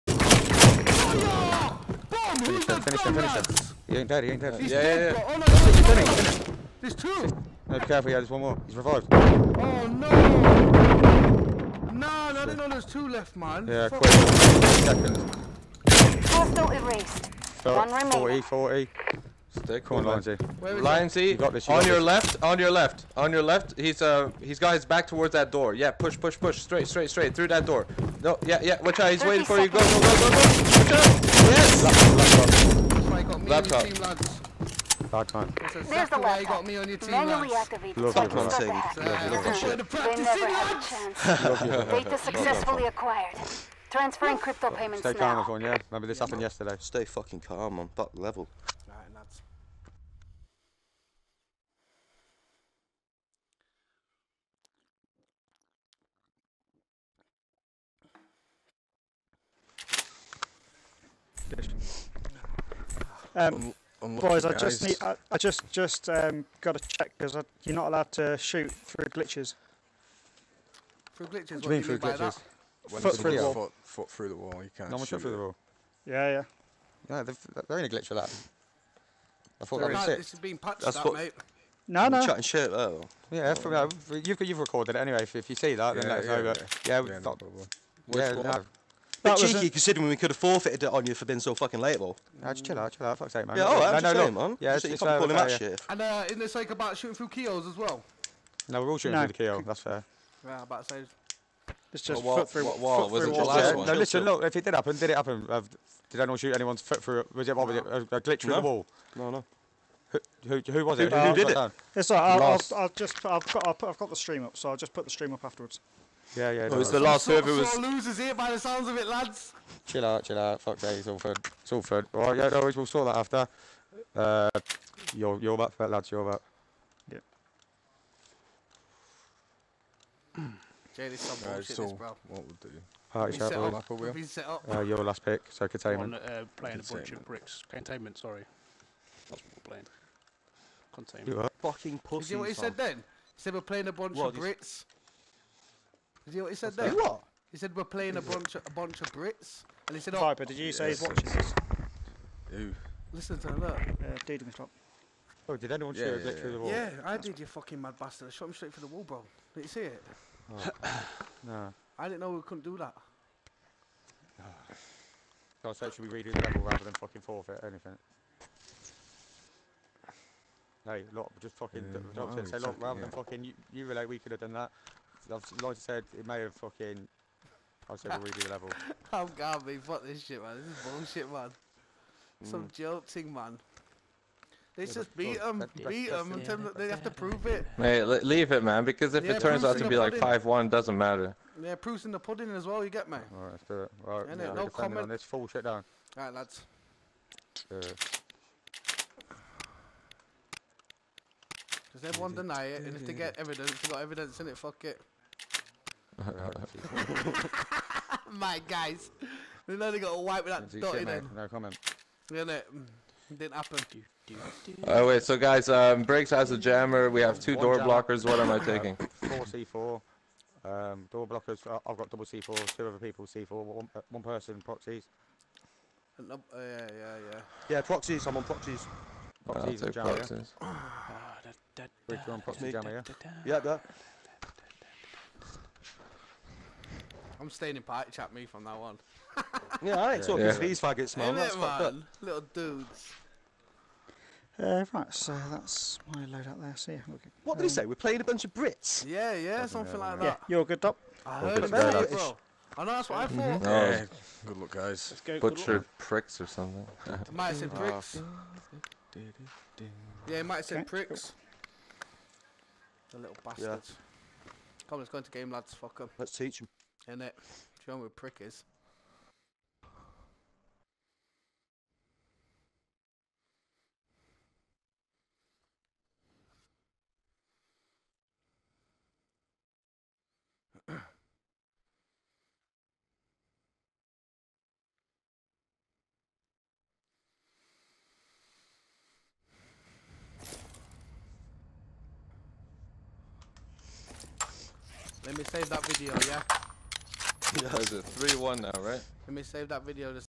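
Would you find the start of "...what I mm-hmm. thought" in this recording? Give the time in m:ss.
4:13.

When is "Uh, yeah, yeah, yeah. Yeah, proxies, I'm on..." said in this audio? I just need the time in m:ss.
3:46.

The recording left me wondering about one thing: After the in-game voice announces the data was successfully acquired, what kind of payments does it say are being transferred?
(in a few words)
crypto.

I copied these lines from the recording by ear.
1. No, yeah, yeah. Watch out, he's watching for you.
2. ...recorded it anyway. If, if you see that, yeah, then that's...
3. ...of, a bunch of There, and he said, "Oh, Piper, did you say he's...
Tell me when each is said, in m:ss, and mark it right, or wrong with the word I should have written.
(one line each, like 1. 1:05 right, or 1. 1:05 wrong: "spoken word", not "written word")
1. 0:28 wrong: "waiting", not "watching"
2. 1:24 right
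3. 2:28 wrong: "Brits", not "There".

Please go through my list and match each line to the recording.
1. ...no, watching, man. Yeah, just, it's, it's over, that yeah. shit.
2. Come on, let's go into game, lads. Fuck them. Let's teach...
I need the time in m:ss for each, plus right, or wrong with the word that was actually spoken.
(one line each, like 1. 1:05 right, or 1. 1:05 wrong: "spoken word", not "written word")
1. 1:34 wrong: "saying", not "watching"
2. 4:24 right.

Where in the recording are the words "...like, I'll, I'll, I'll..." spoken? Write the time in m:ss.
1:52.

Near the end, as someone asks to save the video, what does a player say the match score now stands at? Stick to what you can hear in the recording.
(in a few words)
3-1.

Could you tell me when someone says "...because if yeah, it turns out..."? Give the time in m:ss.
3:08.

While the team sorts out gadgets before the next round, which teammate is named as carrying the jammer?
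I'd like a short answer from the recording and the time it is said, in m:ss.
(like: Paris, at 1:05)
Briggs, at 3:36.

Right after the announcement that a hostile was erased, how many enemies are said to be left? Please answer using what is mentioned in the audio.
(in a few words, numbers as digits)
1.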